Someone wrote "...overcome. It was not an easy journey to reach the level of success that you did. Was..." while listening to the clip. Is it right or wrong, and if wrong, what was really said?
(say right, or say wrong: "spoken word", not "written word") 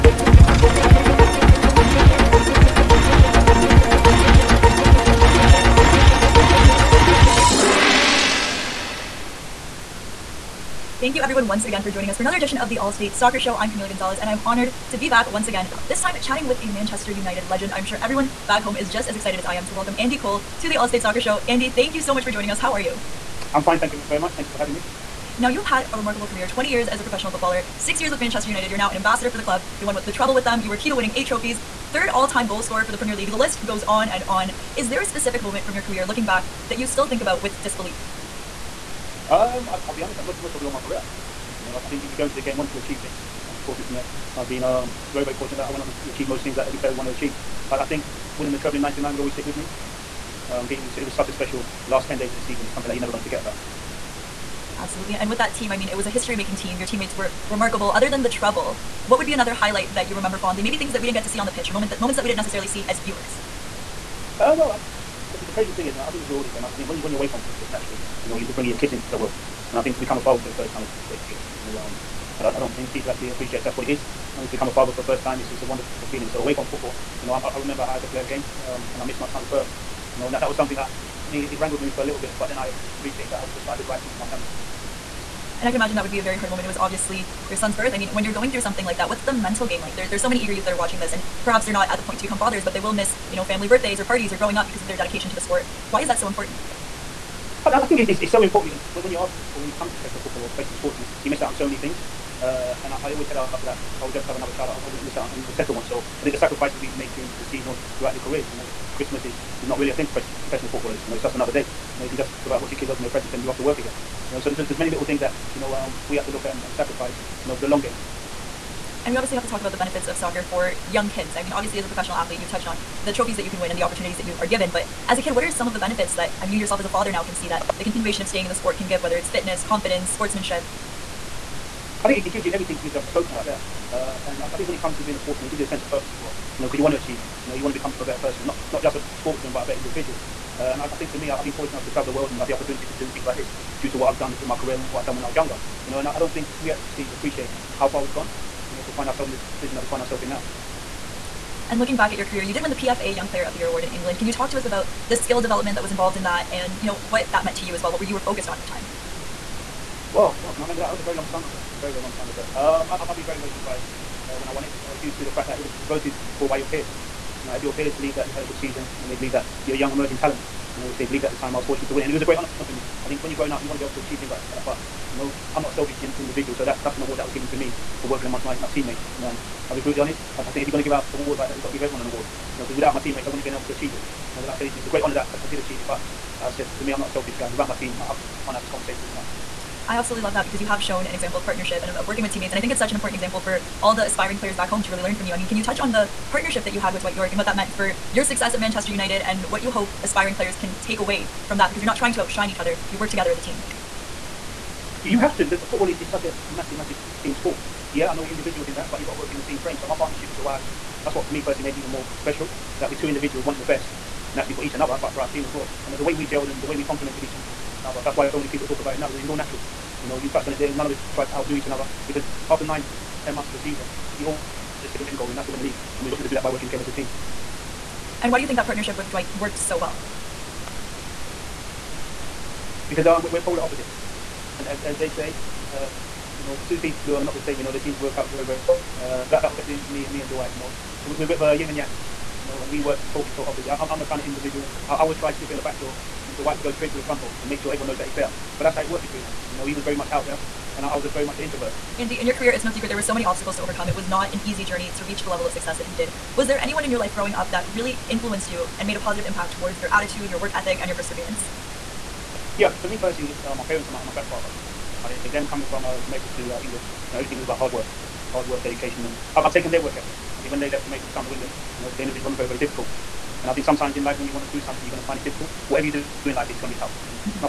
right.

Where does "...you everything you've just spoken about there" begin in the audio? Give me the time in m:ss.
2:12.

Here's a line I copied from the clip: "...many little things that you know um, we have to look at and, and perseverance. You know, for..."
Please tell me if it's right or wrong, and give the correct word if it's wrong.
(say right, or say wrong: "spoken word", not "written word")
wrong: "sacrifice", not "perseverance".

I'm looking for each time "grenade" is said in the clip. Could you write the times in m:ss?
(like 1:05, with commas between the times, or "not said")
not said.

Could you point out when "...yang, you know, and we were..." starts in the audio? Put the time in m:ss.
4:01.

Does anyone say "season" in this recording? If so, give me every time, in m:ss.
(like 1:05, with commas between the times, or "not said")
0:52, 1:47, 2:48, 3:43.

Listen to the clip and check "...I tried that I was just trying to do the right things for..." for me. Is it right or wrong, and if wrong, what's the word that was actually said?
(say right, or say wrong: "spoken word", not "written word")
wrong: "appreciated", not "tried".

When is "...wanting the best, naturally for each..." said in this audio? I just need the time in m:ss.
3:33.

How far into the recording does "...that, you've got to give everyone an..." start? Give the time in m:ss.
3:01.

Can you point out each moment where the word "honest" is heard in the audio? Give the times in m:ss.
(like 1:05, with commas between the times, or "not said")
0:40, 3:00.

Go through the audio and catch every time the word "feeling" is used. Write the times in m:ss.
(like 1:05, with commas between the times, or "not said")
1:11, 1:16.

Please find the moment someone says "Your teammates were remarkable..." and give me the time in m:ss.
0:56.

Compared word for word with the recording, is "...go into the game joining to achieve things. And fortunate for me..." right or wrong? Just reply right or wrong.
wrong.